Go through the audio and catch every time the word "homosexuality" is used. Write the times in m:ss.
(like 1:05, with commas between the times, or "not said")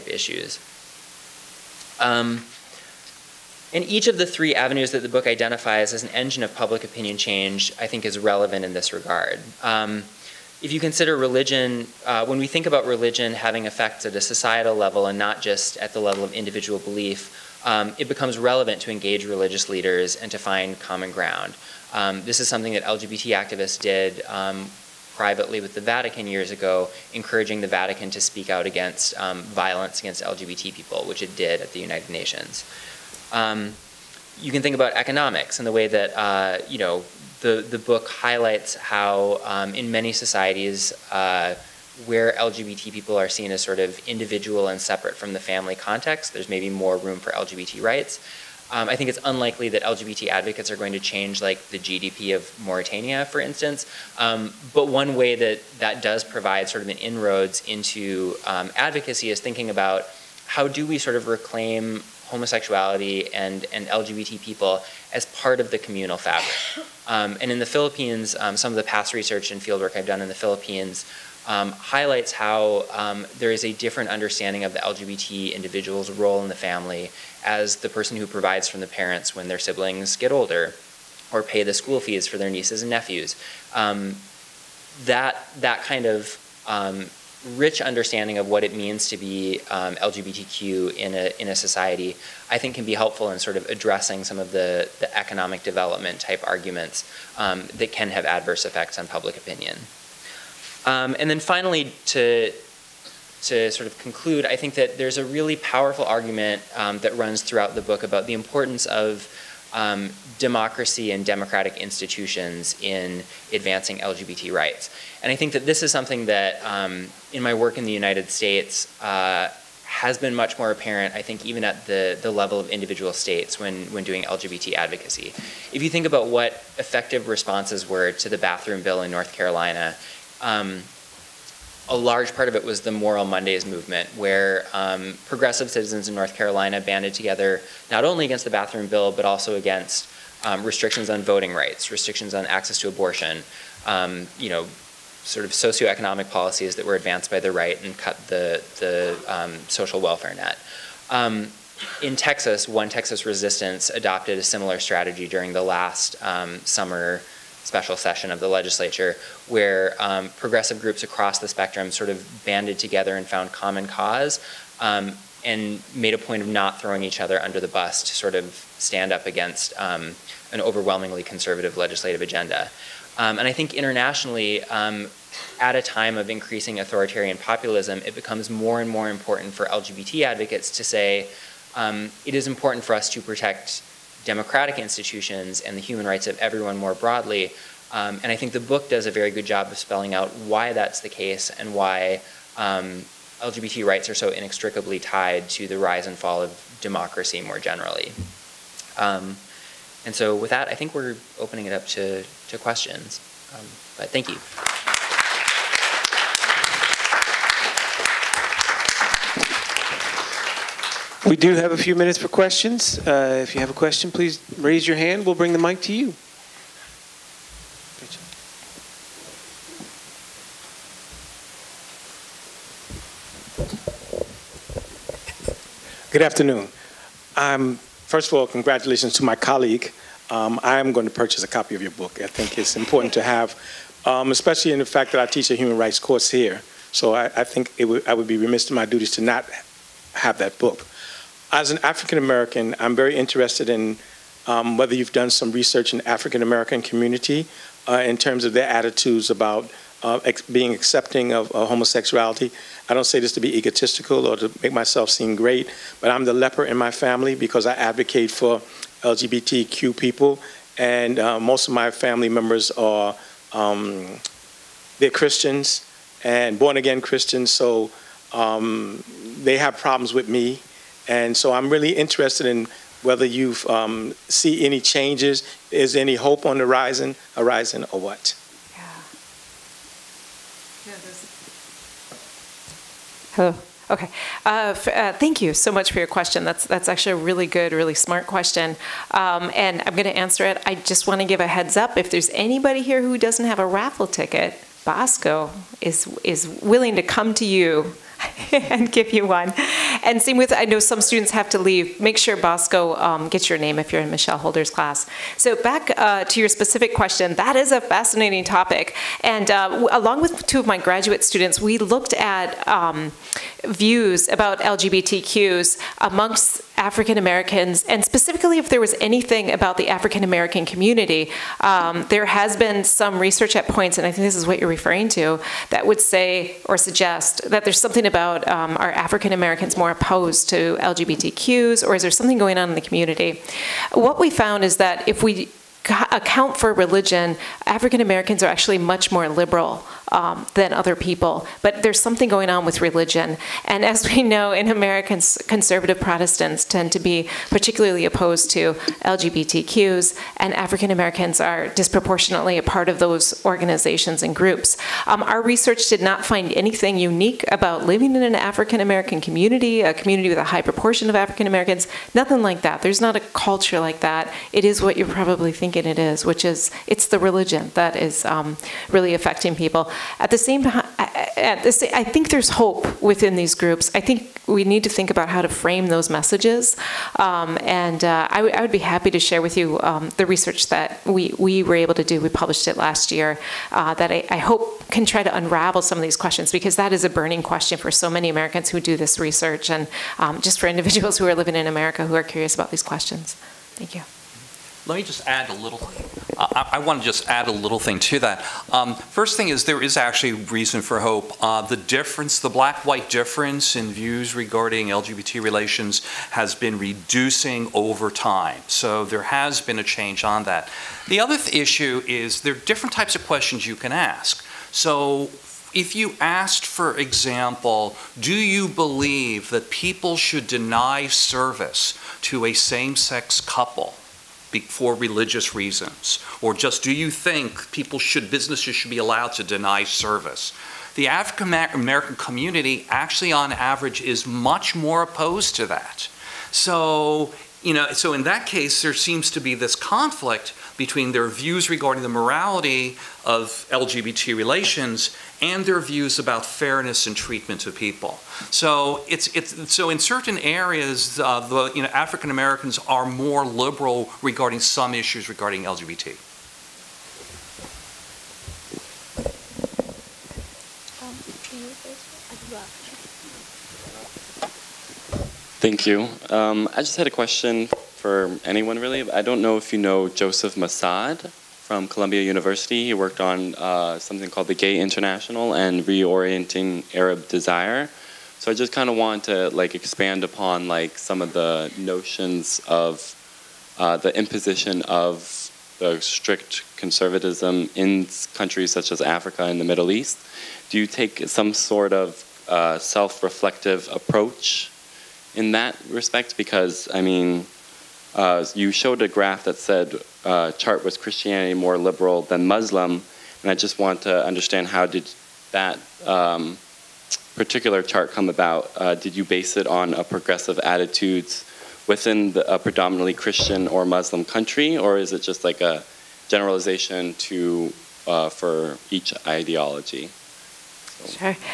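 1:02, 4:11.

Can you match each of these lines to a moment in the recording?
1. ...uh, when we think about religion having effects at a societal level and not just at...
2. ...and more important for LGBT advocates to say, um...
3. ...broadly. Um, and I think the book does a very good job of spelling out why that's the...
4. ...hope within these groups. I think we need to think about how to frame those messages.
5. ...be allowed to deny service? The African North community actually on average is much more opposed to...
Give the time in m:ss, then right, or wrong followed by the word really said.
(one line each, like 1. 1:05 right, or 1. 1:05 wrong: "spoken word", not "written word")
1. 0:12 right
2. 2:58 right
3. 3:06 right
4. 6:12 right
5. 7:08 wrong: "American", not "North".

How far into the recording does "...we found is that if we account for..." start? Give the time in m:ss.
5:34.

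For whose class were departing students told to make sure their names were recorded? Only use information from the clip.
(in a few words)
Michelle Holder.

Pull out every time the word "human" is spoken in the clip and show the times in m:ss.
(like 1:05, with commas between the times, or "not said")
3:05, 3:55.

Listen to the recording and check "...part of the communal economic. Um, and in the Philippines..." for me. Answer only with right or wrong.
wrong.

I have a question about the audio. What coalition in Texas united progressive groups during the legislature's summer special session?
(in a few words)
One Texas Resistance.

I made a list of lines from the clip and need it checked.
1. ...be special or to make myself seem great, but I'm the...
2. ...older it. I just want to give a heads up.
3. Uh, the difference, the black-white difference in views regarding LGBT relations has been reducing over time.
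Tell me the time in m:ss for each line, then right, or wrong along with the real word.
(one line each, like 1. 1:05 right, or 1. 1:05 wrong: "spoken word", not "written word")
1. 4:13 wrong: "egotistical", not "special"
2. 4:50 wrong: "answer", not "older"
3. 6:41 right.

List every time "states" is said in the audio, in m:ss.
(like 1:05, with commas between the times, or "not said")
1:58, 2:03.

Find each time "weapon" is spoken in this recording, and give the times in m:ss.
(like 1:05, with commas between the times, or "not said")
not said.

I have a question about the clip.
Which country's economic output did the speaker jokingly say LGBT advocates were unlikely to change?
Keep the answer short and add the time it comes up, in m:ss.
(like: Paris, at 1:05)
Mauritania, at 0:52.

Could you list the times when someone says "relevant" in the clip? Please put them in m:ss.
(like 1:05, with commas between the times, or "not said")
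0:08, 0:18.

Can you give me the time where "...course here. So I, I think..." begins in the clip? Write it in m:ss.
3:55.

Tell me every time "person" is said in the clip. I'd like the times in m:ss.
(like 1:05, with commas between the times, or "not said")
1:17.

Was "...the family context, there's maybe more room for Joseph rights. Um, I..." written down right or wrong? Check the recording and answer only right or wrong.
wrong.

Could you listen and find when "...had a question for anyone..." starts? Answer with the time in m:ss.
7:46.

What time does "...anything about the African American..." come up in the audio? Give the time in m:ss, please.
5:19.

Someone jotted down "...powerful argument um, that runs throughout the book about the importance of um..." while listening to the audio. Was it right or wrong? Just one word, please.
right.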